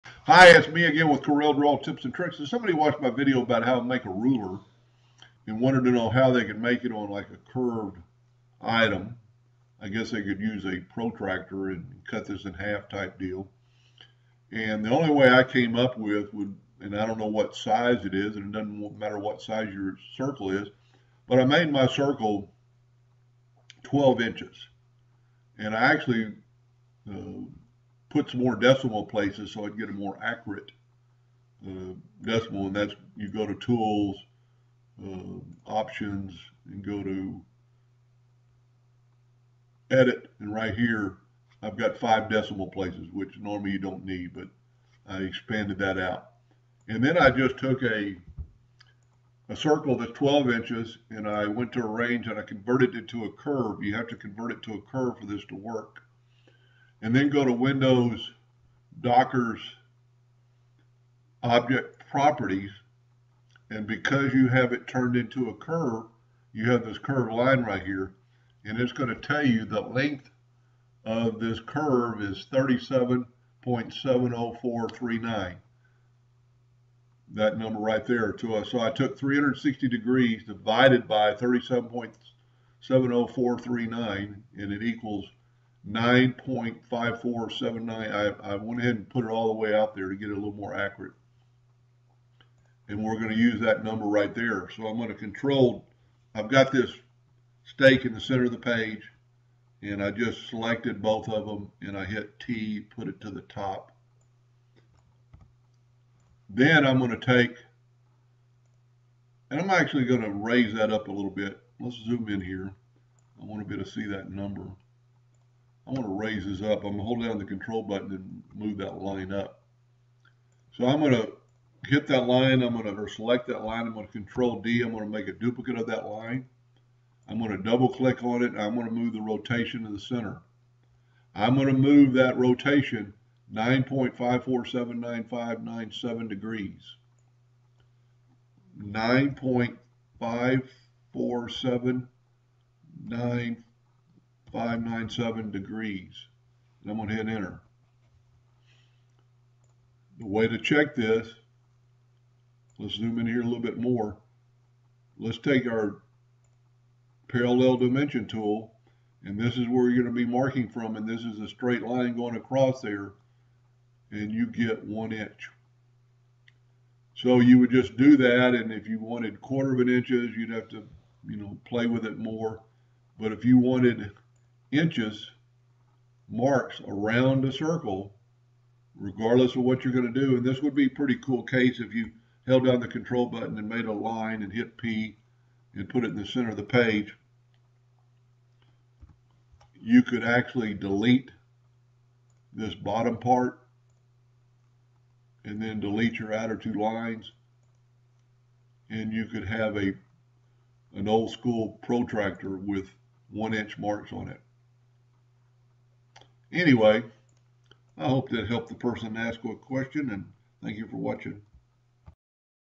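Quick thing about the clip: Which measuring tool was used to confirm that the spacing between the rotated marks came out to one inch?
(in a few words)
parallel dimension tool.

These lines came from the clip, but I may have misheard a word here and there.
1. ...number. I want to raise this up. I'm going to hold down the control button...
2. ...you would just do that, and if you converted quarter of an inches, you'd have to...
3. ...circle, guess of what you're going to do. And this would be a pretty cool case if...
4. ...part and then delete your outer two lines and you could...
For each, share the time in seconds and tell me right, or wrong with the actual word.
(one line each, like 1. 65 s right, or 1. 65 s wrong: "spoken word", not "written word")
1. 114 s right
2. 167 s wrong: "wanted", not "converted"
3. 177 s wrong: "regardless", not "guess"
4. 193 s right.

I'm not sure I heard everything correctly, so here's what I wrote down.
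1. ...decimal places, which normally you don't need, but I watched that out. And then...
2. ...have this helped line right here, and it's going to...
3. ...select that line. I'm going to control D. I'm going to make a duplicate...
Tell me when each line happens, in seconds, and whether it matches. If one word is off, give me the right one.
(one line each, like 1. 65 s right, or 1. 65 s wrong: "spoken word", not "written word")
1. 42 s wrong: "expanded", not "watched"
2. 66 s wrong: "curved", not "helped"
3. 123 s right.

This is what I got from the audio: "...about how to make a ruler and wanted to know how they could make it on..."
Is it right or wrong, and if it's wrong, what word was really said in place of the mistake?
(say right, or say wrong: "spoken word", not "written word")
right.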